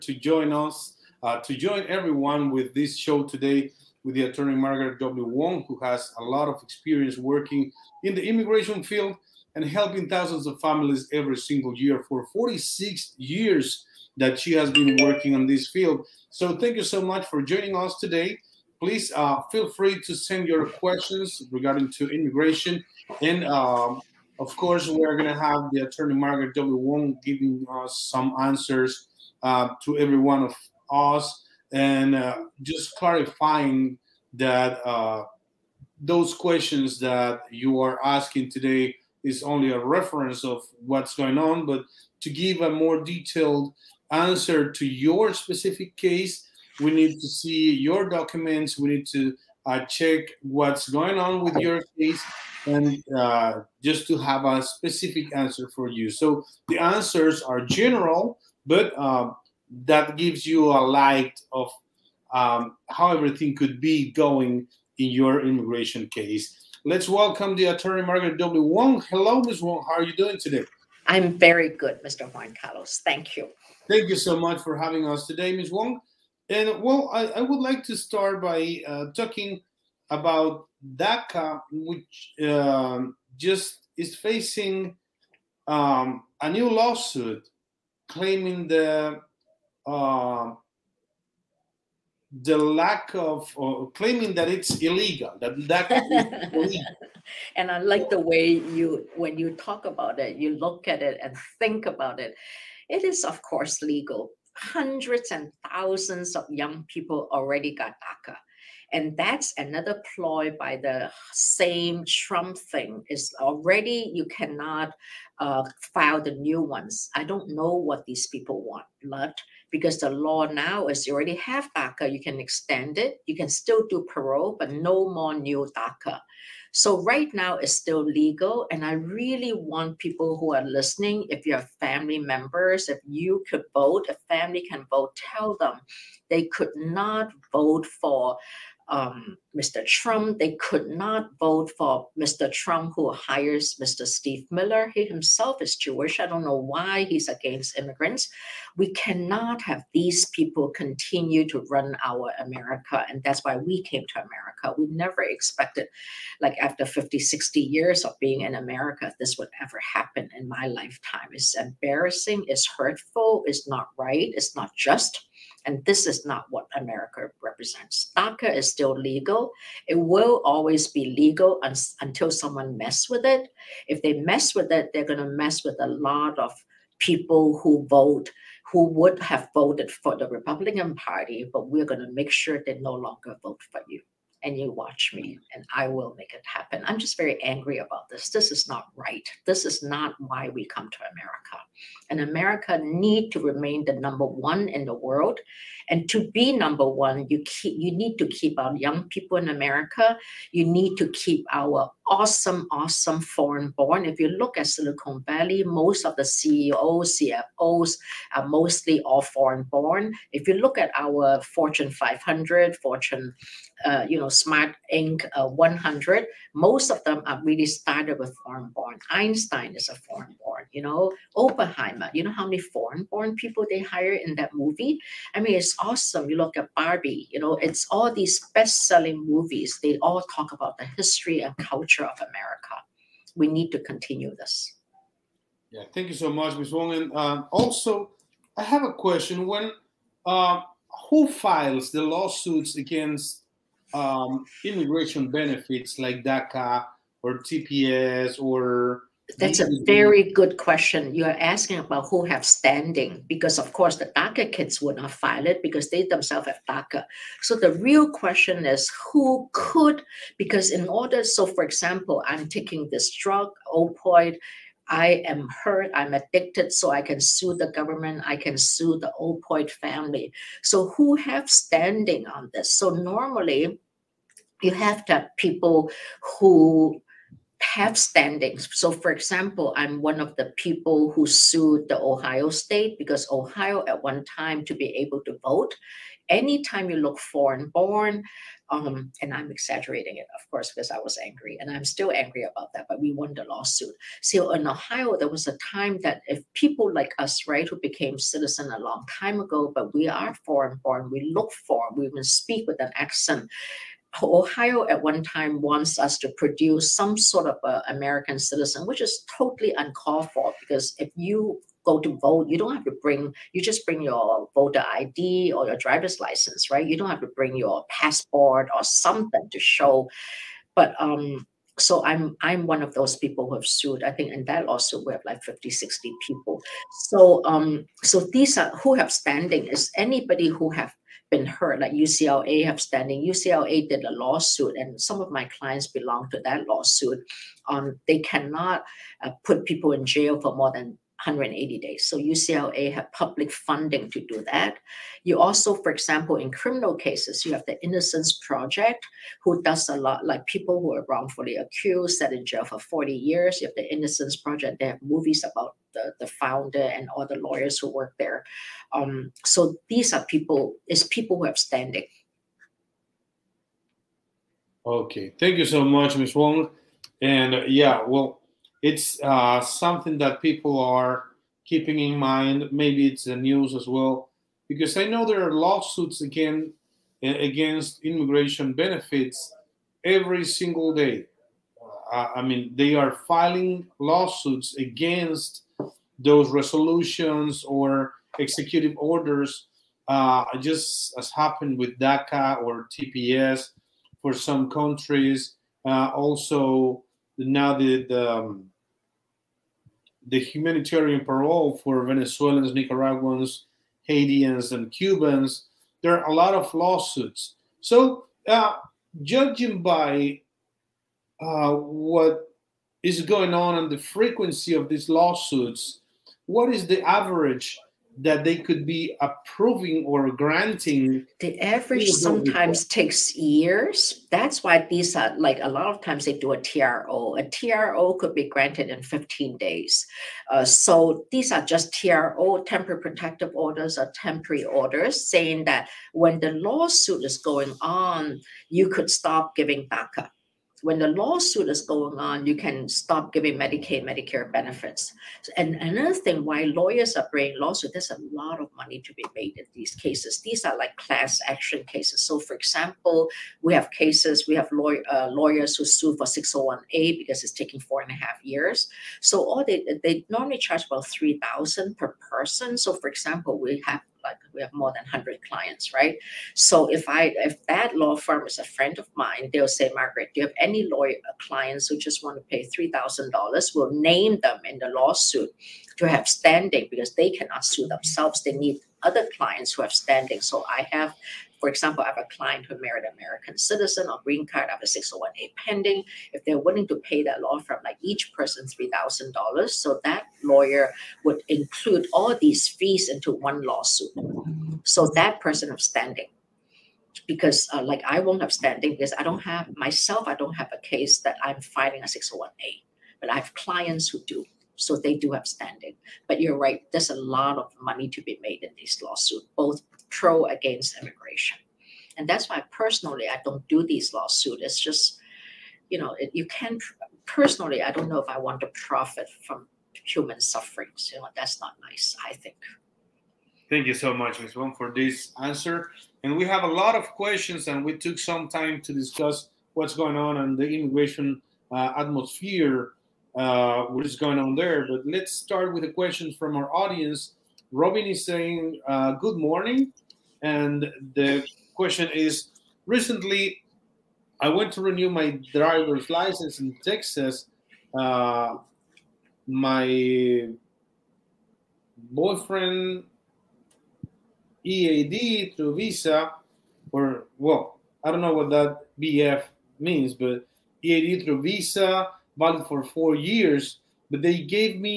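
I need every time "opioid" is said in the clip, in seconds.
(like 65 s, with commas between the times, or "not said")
263 s, 269 s.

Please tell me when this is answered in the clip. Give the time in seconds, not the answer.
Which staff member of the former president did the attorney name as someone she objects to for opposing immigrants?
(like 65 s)
143 s.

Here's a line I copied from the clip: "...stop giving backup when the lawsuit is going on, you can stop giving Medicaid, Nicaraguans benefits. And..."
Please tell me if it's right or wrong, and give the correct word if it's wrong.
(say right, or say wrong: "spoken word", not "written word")
wrong: "Medicare", not "Nicaraguans".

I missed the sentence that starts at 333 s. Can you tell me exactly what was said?
UCLA did a lawsuit, and some of my clients belong to that lawsuit.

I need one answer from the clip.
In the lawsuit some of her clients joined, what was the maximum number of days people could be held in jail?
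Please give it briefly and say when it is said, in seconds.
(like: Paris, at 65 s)
180 days, at 341 s.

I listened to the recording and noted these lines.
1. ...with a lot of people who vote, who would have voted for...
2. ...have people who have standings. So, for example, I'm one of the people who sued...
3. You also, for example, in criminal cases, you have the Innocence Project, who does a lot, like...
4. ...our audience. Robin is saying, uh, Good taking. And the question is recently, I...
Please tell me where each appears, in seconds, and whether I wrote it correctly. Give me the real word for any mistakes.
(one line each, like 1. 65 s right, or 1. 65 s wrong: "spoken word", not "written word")
1. 175 s right
2. 275 s right
3. 345 s right
4. 536 s wrong: "morning", not "taking".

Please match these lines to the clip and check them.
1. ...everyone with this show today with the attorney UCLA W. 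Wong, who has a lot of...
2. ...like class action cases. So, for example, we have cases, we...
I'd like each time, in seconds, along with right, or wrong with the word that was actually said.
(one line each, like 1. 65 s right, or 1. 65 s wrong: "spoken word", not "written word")
1. 1 s wrong: "Margaret", not "UCLA"
2. 450 s right.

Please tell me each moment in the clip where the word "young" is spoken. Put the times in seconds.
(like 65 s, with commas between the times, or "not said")
106 s, 198 s.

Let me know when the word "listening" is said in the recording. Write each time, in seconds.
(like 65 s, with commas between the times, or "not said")
130 s.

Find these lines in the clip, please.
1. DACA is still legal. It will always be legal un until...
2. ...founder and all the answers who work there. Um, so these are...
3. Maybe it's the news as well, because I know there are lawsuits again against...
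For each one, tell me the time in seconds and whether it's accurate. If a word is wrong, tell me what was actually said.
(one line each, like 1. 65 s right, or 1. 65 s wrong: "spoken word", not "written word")
1. 168 s right
2. 356 s wrong: "lawyers", not "answers"
3. 372 s right.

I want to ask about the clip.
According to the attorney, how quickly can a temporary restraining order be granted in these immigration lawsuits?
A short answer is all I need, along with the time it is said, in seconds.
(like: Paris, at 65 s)
15 days, at 429 s.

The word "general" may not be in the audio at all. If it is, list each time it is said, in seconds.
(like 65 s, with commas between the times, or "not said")
57 s.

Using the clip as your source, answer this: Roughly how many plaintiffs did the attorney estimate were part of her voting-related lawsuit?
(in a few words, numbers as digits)
50 to 60.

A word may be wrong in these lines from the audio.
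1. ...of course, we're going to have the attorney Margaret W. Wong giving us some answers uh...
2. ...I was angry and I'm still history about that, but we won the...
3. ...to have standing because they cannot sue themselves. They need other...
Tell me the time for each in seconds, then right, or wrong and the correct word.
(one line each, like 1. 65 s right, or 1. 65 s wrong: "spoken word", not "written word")
1. 24 s right
2. 290 s wrong: "angry", not "history"
3. 475 s right.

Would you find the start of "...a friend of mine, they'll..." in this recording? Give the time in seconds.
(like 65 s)
468 s.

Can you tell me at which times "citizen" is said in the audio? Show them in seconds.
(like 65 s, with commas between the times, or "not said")
298 s, 308 s, 483 s.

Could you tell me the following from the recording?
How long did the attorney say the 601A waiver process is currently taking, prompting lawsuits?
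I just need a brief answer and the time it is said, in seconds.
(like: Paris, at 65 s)
4 and a half years, at 457 s.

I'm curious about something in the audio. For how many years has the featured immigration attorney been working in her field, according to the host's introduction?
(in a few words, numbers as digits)
46.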